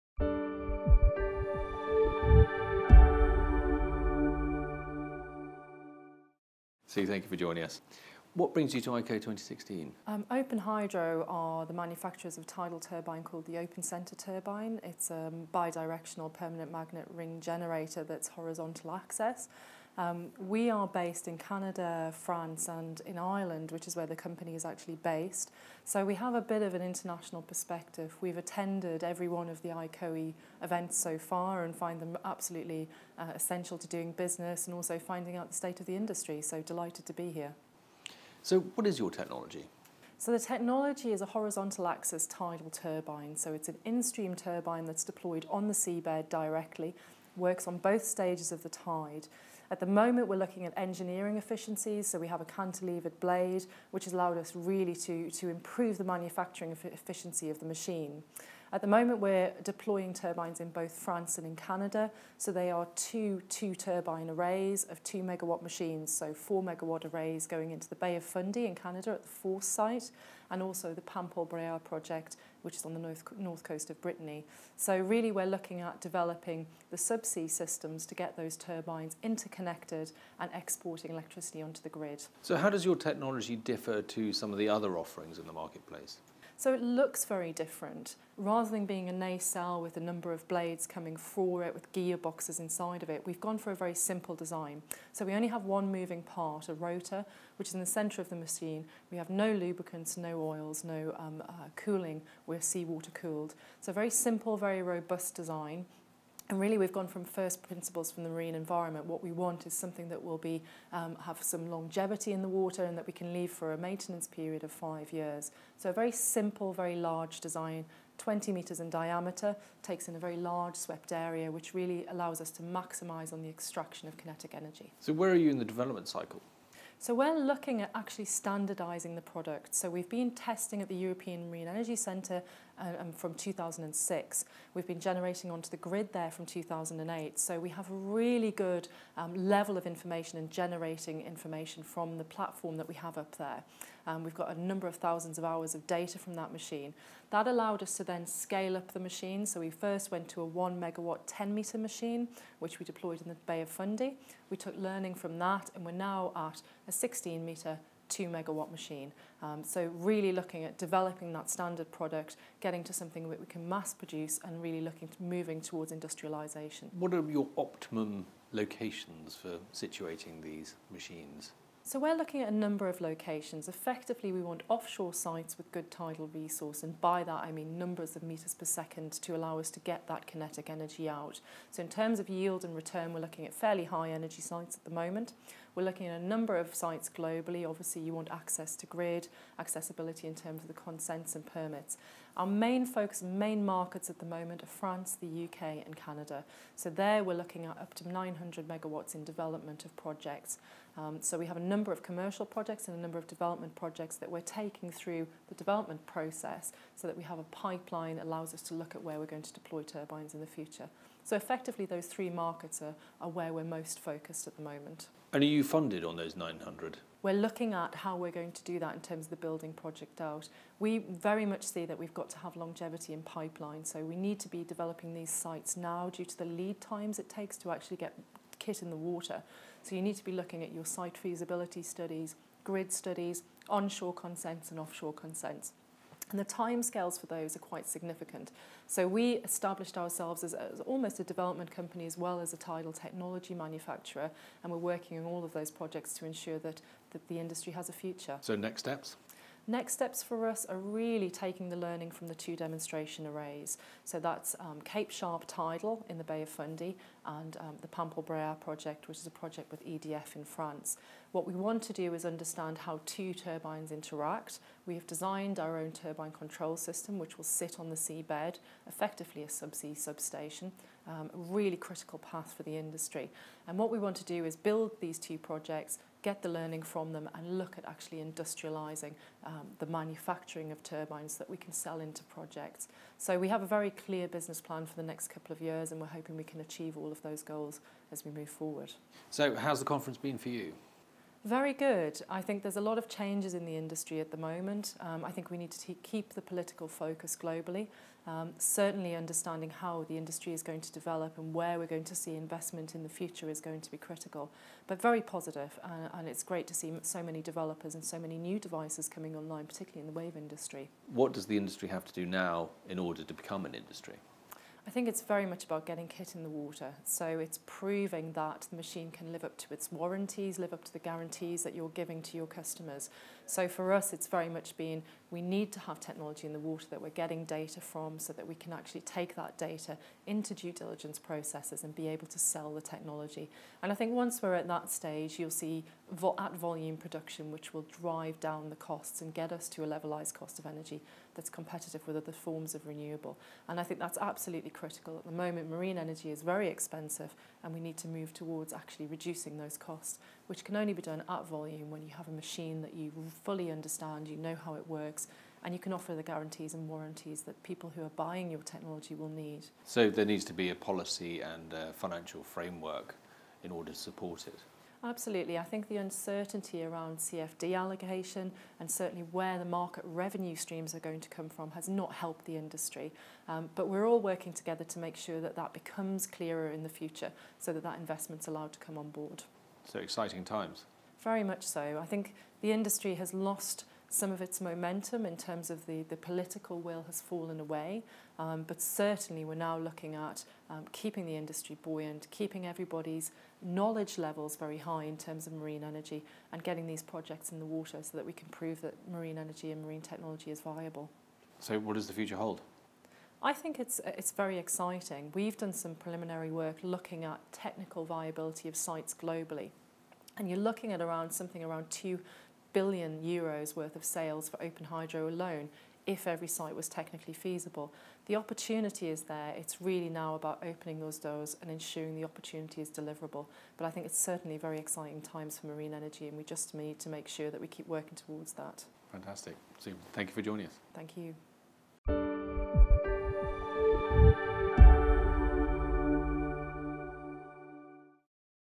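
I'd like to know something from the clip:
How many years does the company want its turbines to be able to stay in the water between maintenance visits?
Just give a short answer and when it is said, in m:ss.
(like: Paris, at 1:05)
5 years, at 1:54.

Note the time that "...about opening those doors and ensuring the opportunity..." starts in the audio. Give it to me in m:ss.
7:00.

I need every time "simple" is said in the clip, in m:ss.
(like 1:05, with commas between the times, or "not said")
1:33, 1:44, 1:56.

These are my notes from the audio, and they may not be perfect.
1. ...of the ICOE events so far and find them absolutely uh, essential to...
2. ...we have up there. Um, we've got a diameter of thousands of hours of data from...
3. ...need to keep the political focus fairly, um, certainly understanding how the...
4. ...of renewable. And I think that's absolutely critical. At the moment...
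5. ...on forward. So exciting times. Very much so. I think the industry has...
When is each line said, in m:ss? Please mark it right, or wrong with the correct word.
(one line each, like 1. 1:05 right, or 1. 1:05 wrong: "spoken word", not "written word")
1. 0:29 right
2. 2:22 wrong: "number", not "diameter"
3. 4:55 wrong: "globally", not "fairly"
4. 5:42 right
5. 6:18 wrong: "board", not "forward".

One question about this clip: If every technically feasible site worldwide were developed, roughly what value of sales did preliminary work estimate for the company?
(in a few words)
2 billion euros.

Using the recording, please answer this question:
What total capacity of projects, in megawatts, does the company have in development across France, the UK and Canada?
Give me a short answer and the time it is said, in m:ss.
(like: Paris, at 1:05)
900 megawatts, at 3:18.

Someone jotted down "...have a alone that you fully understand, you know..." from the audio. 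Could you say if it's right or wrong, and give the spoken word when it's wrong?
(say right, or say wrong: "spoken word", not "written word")
wrong: "machine", not "alone".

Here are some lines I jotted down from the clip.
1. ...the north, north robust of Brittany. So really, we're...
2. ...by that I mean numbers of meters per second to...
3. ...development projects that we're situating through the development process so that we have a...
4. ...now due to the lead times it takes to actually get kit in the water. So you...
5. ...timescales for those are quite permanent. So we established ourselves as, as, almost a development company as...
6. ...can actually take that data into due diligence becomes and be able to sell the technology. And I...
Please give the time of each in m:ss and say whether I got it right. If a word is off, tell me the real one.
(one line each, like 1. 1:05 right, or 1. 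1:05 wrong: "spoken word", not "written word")
1. 1:12 wrong: "coast", not "robust"
2. 2:57 right
3. 3:23 wrong: "taking", not "situating"
4. 3:45 right
5. 3:56 wrong: "significant", not "permanent"
6. 5:28 wrong: "processes", not "becomes".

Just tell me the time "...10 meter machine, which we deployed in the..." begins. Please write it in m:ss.
2:31.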